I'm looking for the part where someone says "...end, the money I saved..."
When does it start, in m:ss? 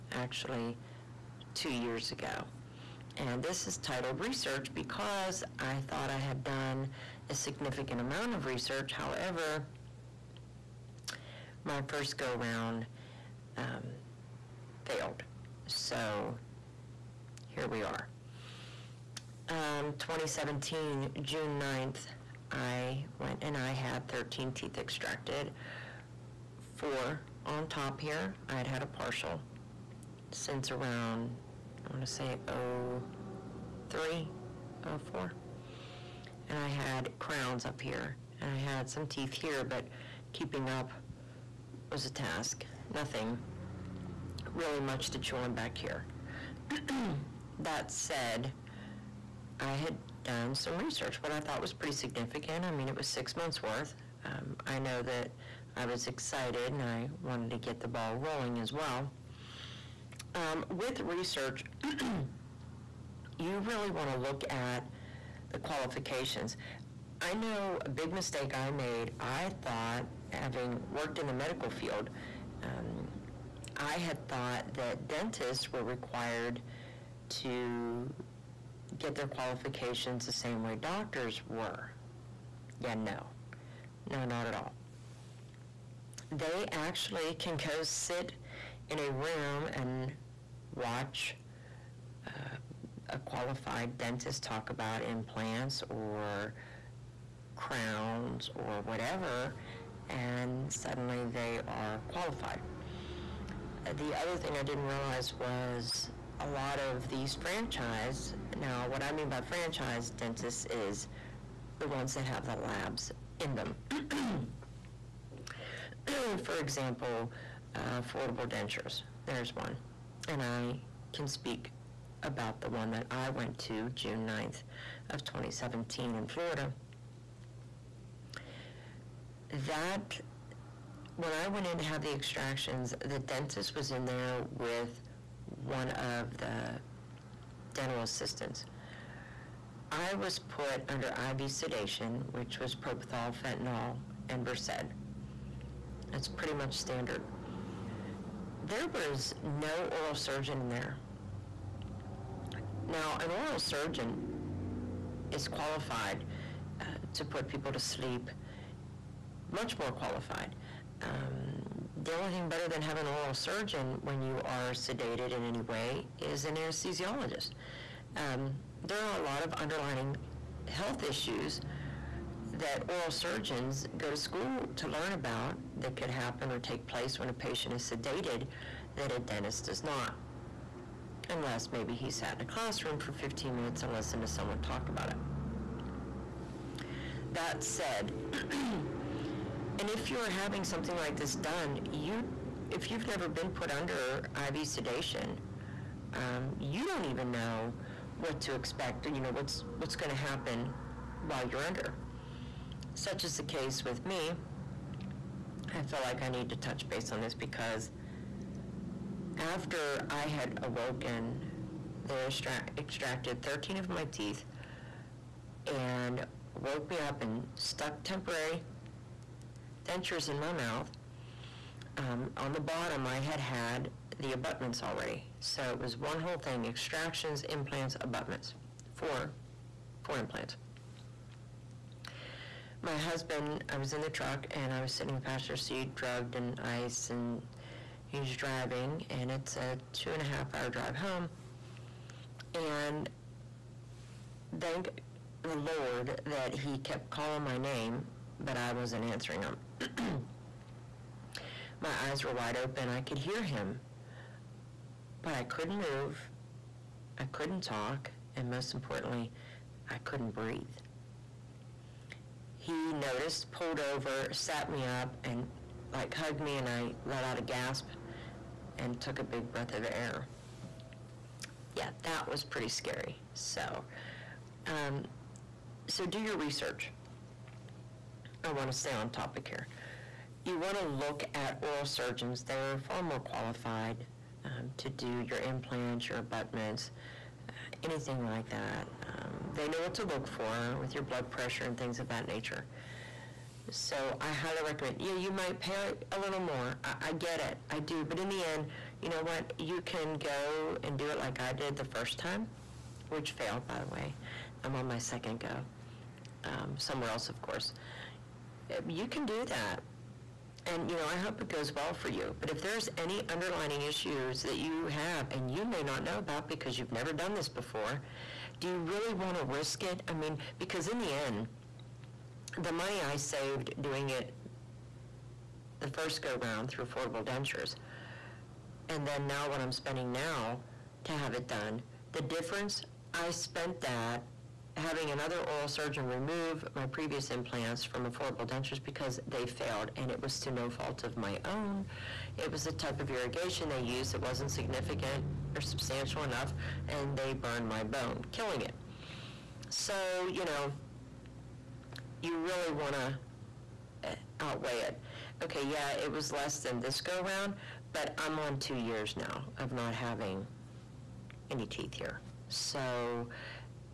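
5:21.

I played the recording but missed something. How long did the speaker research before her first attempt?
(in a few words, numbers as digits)
6 months.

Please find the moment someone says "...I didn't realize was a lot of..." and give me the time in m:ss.
1:44.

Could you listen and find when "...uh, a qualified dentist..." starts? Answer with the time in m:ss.
1:32.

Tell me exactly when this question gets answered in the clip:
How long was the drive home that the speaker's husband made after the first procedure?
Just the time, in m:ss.
3:59.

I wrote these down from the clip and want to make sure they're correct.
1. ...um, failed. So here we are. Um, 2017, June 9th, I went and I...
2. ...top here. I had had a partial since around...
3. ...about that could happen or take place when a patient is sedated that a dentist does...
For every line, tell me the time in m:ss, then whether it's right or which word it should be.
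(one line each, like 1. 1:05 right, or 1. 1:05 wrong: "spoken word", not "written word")
1. 0:13 right
2. 0:27 right
3. 2:55 right.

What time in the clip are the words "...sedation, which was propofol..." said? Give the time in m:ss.
2:21.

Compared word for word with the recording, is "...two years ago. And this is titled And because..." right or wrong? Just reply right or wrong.
wrong.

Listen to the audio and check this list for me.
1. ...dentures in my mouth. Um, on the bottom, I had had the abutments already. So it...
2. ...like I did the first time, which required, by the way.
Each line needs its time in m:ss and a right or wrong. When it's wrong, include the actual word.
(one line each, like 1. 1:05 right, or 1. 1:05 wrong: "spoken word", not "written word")
1. 3:39 right
2. 5:01 wrong: "failed", not "required".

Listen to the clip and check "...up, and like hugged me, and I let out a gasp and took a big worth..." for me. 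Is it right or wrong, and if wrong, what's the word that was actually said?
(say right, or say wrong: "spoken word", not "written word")
wrong: "breath", not "worth".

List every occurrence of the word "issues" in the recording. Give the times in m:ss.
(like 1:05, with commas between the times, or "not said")
2:51, 5:13.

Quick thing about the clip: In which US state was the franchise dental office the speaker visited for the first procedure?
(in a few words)
Florida.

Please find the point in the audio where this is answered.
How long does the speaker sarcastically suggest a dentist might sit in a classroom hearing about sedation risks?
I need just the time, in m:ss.
3:03.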